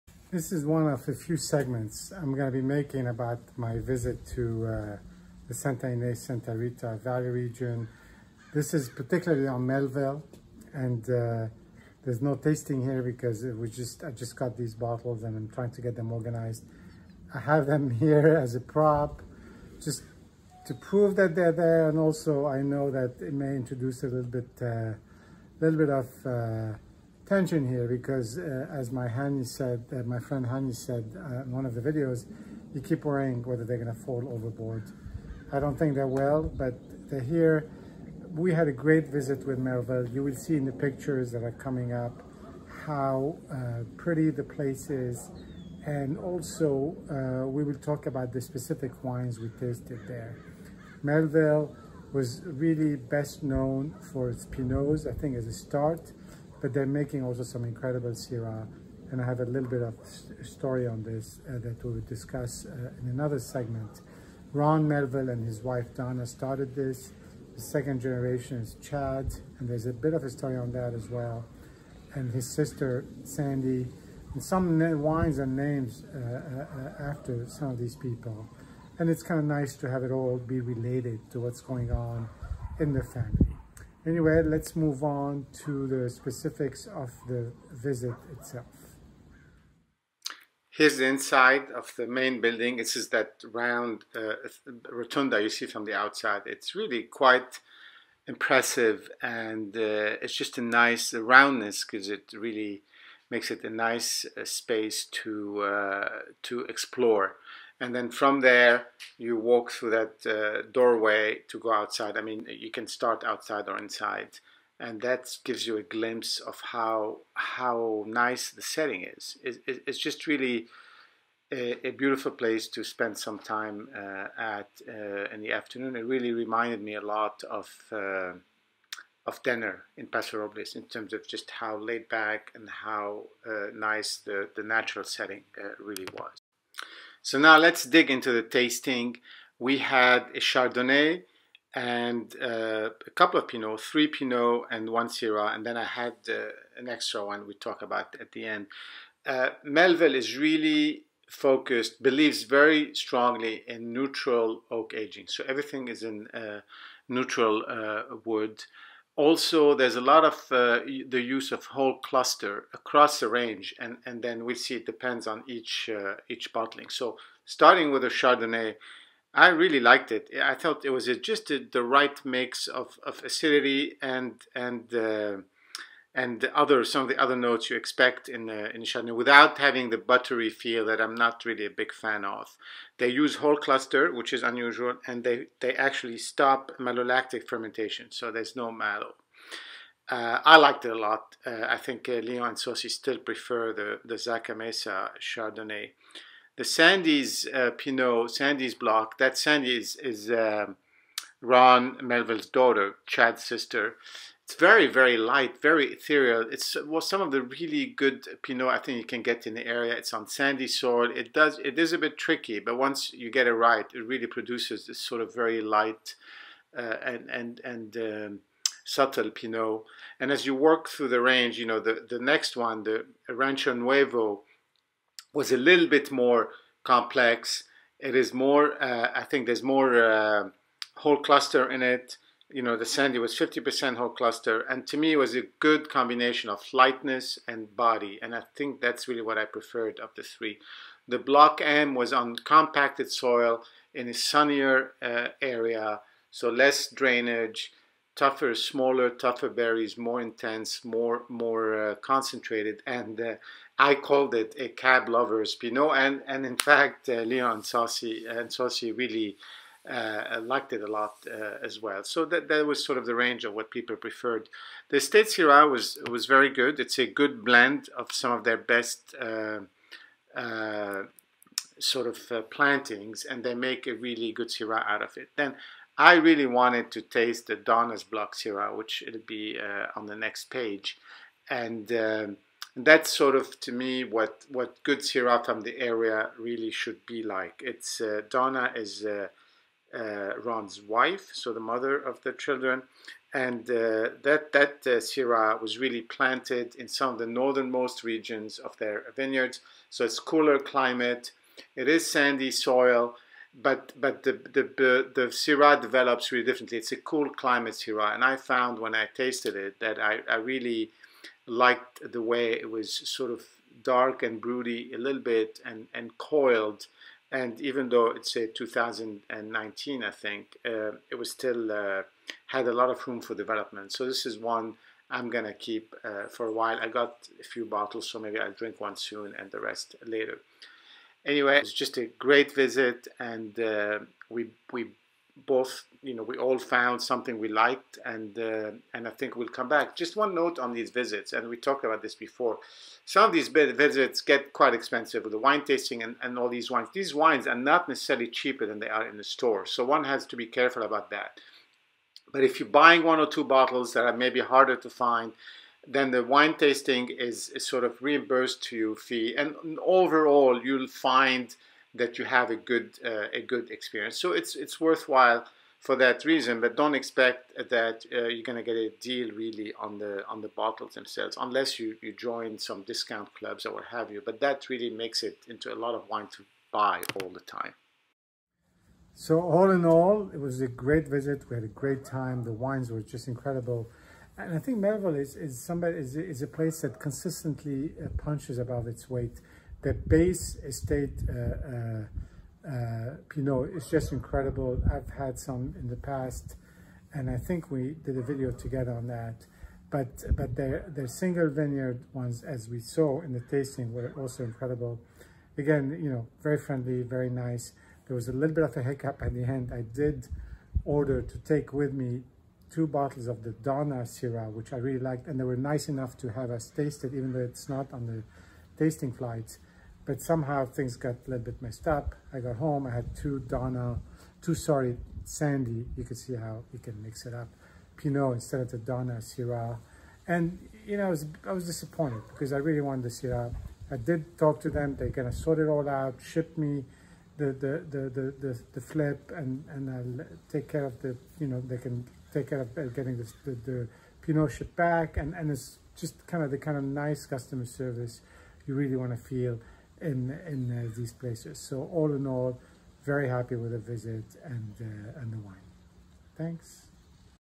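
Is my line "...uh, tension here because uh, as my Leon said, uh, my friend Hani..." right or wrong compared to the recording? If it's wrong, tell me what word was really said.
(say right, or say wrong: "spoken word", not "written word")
wrong: "Hani", not "Leon".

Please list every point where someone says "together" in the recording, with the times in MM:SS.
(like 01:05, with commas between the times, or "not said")
06:38.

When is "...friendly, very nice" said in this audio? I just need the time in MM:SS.
06:46.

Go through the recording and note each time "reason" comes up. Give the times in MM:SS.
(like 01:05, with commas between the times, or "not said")
06:06.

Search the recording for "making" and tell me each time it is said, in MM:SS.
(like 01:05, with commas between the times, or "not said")
00:02, 00:56.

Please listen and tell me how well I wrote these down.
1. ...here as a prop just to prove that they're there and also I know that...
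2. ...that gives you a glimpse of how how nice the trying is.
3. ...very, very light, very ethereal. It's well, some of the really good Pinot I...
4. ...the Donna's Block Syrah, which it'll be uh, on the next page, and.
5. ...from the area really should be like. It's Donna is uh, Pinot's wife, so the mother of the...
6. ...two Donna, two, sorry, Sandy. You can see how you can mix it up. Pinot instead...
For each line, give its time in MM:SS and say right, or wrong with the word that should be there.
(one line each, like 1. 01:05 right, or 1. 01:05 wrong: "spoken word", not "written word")
1. 00:18 right
2. 01:55 wrong: "setting", not "trying"
3. 03:24 right
4. 04:37 right
5. 04:45 wrong: "Ron", not "Pinot"
6. 07:03 right.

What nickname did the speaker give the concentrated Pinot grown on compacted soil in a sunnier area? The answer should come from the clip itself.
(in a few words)
a cab lover's Pinot.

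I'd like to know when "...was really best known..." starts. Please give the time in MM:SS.
00:52.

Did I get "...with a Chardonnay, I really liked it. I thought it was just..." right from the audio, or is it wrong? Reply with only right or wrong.
right.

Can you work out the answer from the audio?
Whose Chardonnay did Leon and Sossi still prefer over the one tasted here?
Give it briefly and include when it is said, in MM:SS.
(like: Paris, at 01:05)
Zaca Mesa, at 03:14.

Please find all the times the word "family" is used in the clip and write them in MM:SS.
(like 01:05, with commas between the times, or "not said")
01:23.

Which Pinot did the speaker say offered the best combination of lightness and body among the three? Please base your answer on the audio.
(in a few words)
Rancho Nuevo.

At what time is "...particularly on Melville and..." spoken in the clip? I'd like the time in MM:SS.
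00:08.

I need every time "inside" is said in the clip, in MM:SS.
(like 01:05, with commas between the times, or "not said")
01:31, 01:53.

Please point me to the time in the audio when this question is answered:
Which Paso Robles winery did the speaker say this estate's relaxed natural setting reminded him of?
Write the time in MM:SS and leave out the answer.
02:09.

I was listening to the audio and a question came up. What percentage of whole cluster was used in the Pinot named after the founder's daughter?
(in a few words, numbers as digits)
50%.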